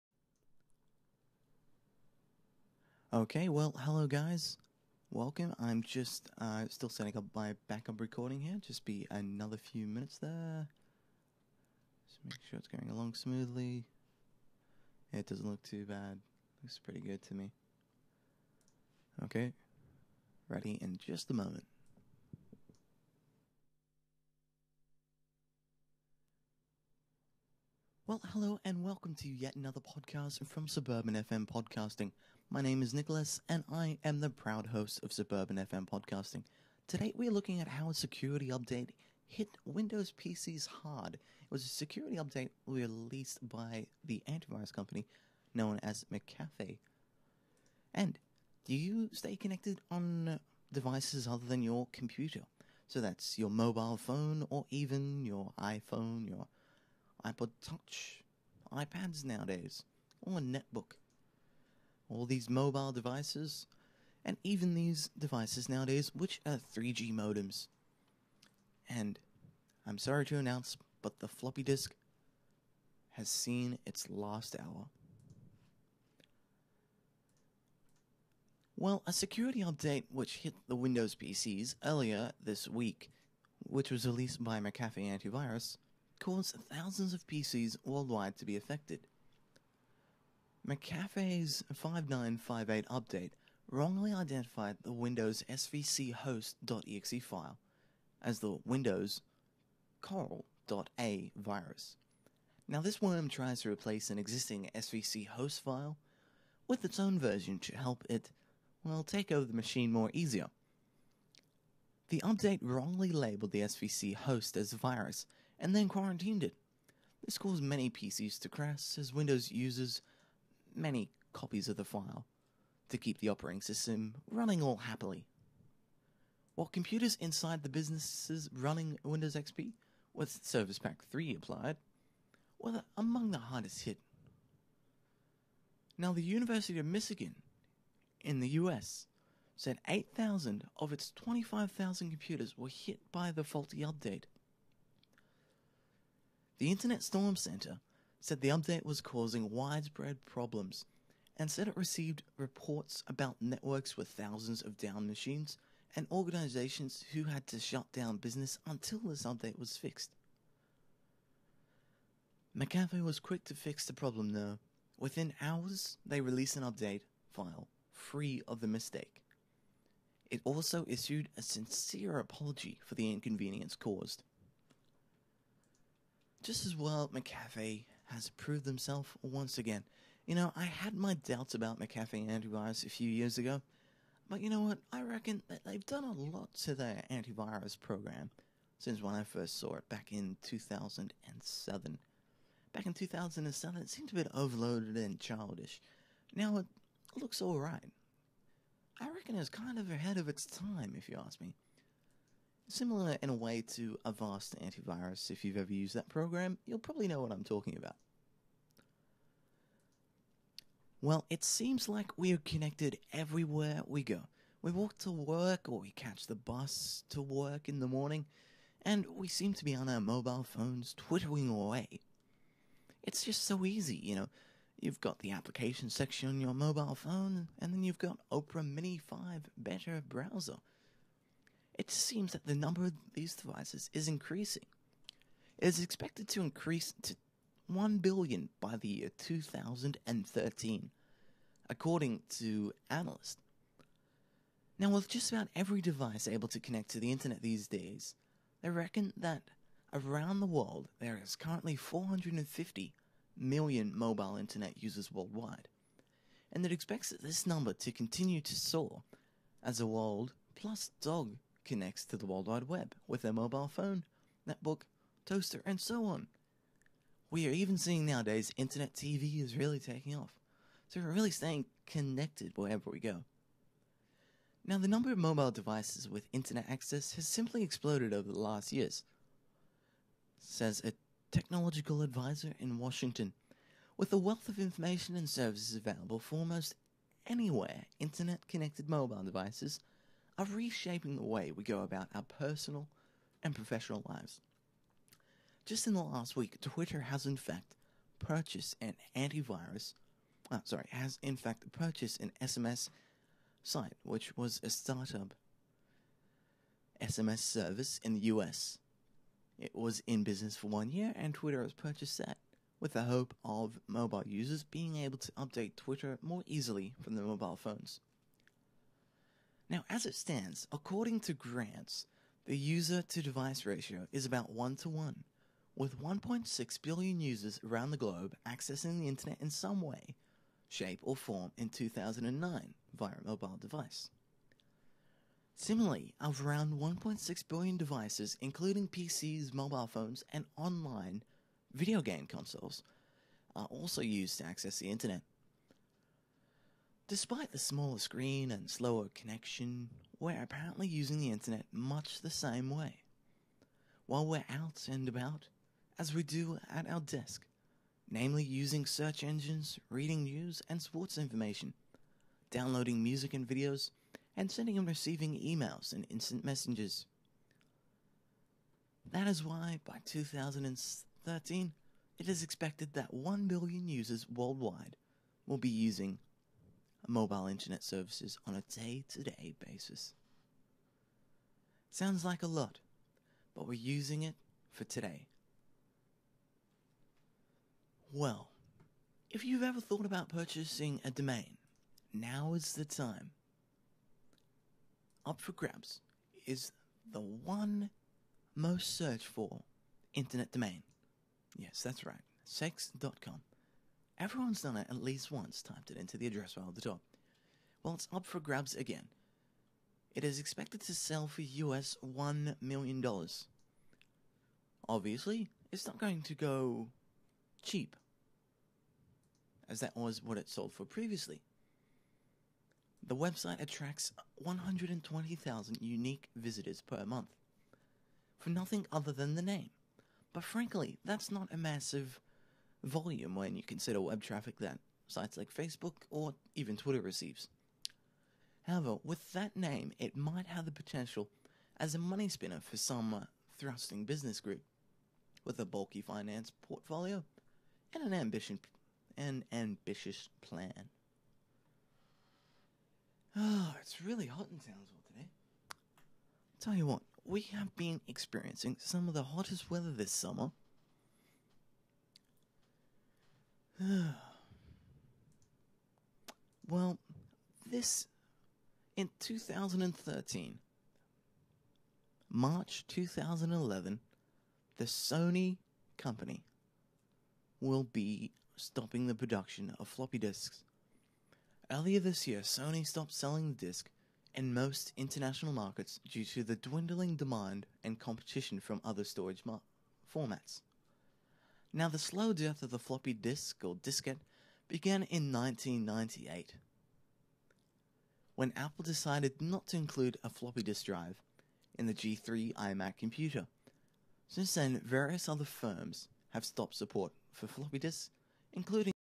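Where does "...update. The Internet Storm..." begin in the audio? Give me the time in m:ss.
2:23.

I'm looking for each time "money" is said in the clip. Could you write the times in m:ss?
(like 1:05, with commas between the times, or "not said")
7:21.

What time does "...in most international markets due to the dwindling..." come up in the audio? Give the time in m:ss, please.
8:04.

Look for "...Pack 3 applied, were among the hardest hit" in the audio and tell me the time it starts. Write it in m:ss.
2:10.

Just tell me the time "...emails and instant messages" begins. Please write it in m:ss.
6:05.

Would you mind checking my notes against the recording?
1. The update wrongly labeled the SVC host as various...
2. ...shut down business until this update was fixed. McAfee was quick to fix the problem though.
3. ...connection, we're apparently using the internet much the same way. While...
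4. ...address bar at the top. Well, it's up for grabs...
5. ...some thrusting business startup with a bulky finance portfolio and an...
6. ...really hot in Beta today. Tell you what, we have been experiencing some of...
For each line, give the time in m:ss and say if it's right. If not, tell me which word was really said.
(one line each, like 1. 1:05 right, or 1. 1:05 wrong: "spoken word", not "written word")
1. 1:52 wrong: "virus", not "various"
2. 2:37 right
3. 5:49 right
4. 6:46 right
5. 7:22 wrong: "group", not "startup"
6. 7:34 wrong: "Townsville", not "Beta".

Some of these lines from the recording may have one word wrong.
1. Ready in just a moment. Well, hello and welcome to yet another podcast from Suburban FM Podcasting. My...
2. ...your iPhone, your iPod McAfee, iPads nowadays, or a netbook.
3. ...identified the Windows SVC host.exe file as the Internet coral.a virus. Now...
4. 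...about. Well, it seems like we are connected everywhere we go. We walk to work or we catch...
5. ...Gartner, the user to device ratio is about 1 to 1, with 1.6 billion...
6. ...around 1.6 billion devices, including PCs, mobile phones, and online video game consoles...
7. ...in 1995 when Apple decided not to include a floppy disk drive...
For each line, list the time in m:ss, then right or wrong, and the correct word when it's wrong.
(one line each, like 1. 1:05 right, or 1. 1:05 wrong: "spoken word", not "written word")
1. 0:20 right
2. 0:55 wrong: "Touch", not "McAfee"
3. 1:34 wrong: "Windows", not "Internet"
4. 3:27 right
5. 5:21 right
6. 5:36 right
7. 8:15 wrong: "1998", not "1995".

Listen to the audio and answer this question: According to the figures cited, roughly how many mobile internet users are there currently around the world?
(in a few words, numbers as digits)
450 million.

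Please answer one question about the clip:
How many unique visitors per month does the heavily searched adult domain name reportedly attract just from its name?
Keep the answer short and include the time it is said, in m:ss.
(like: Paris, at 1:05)
120,000, at 7:04.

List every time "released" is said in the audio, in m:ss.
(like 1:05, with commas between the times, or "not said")
0:42, 1:24, 2:46.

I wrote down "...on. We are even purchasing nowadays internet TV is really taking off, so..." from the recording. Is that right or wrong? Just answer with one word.
wrong.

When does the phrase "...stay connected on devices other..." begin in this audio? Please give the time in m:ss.
0:49.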